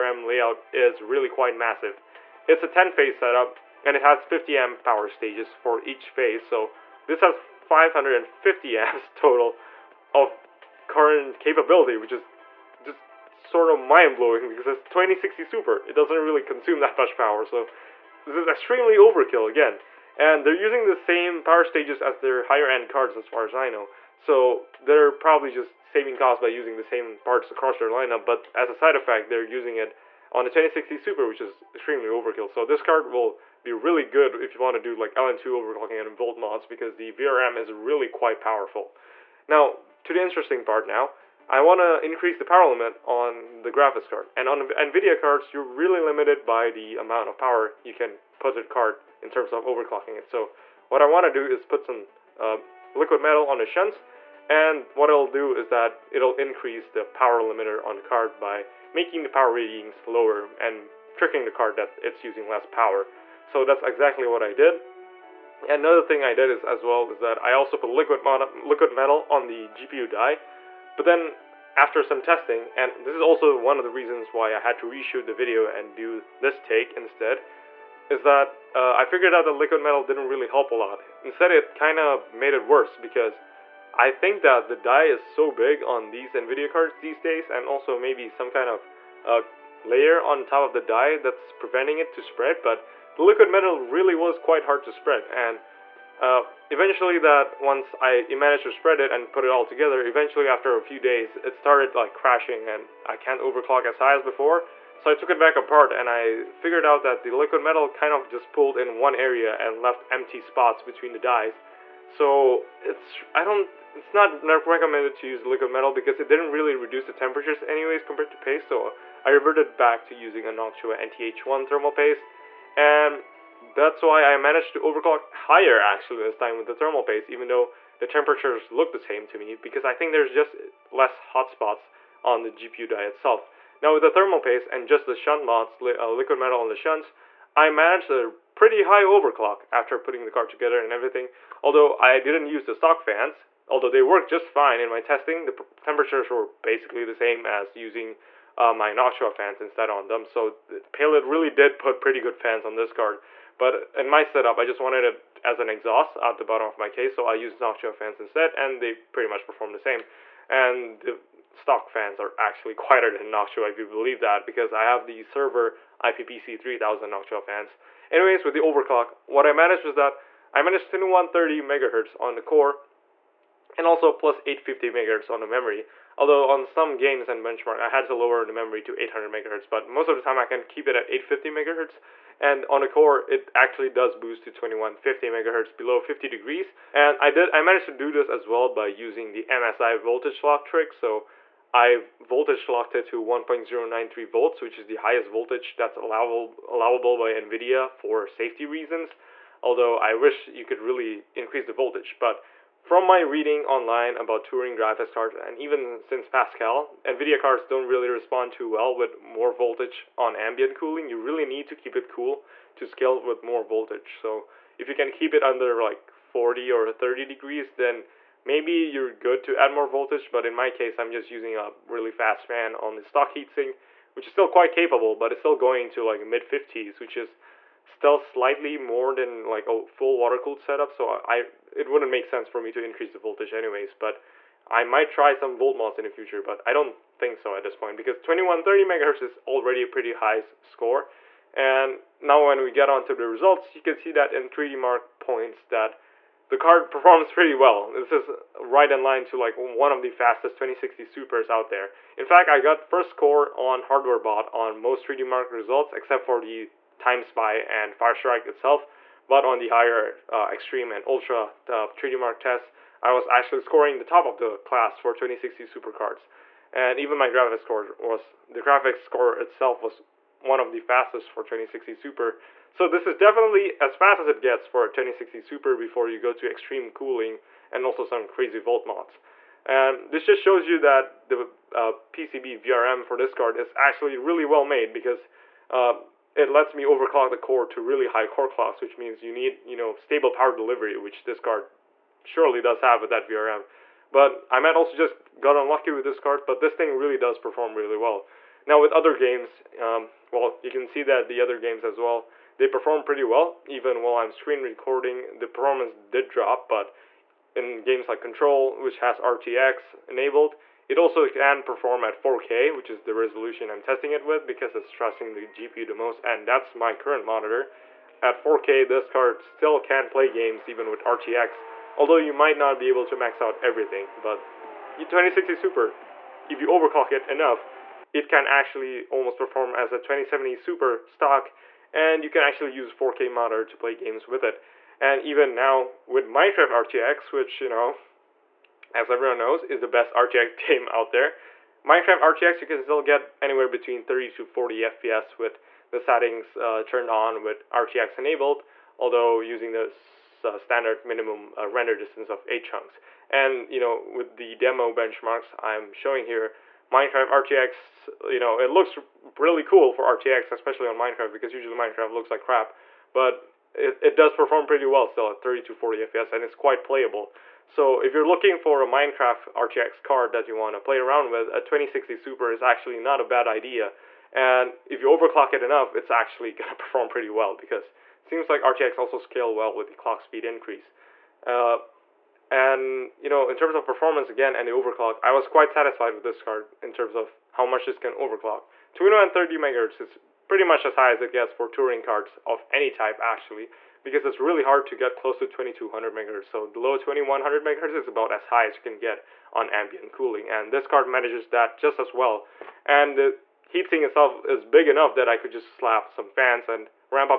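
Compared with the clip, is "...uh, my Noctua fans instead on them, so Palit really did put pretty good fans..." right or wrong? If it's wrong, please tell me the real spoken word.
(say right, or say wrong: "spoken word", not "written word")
right.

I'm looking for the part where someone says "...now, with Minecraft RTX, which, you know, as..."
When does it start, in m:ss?
5:35.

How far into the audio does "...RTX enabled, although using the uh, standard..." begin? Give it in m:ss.
5:47.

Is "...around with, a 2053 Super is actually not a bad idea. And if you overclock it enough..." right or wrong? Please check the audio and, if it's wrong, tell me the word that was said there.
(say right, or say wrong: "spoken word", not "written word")
wrong: "2060", not "2053".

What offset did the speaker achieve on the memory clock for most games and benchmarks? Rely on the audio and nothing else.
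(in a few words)
+850 MHz.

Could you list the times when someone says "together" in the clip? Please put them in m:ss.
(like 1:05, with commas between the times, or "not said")
1:39, 2:20.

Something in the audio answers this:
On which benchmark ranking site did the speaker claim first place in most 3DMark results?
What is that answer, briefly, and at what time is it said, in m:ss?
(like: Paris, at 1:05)
HardwareBot, at 4:13.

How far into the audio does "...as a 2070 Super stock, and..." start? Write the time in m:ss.
5:29.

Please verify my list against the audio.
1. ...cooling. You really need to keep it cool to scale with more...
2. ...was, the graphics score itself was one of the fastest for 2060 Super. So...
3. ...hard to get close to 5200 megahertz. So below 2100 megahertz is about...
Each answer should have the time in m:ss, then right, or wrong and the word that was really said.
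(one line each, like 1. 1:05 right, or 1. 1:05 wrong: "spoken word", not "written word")
1. 3:30 right
2. 4:27 right
3. 6:34 wrong: "2200", not "5200".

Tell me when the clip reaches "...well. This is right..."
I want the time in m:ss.
4:07.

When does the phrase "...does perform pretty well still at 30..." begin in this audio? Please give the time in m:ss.
6:04.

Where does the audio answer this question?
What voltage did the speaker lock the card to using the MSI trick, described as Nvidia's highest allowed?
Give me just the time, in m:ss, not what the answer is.
3:13.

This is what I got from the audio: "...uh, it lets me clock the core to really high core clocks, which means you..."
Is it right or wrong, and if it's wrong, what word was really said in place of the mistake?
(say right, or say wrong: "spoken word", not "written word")
wrong: "overclock", not "clock".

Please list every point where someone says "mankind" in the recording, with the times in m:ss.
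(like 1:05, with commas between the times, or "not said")
not said.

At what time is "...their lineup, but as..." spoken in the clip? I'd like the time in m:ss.
0:27.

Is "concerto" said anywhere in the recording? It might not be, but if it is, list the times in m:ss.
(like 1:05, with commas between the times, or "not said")
not said.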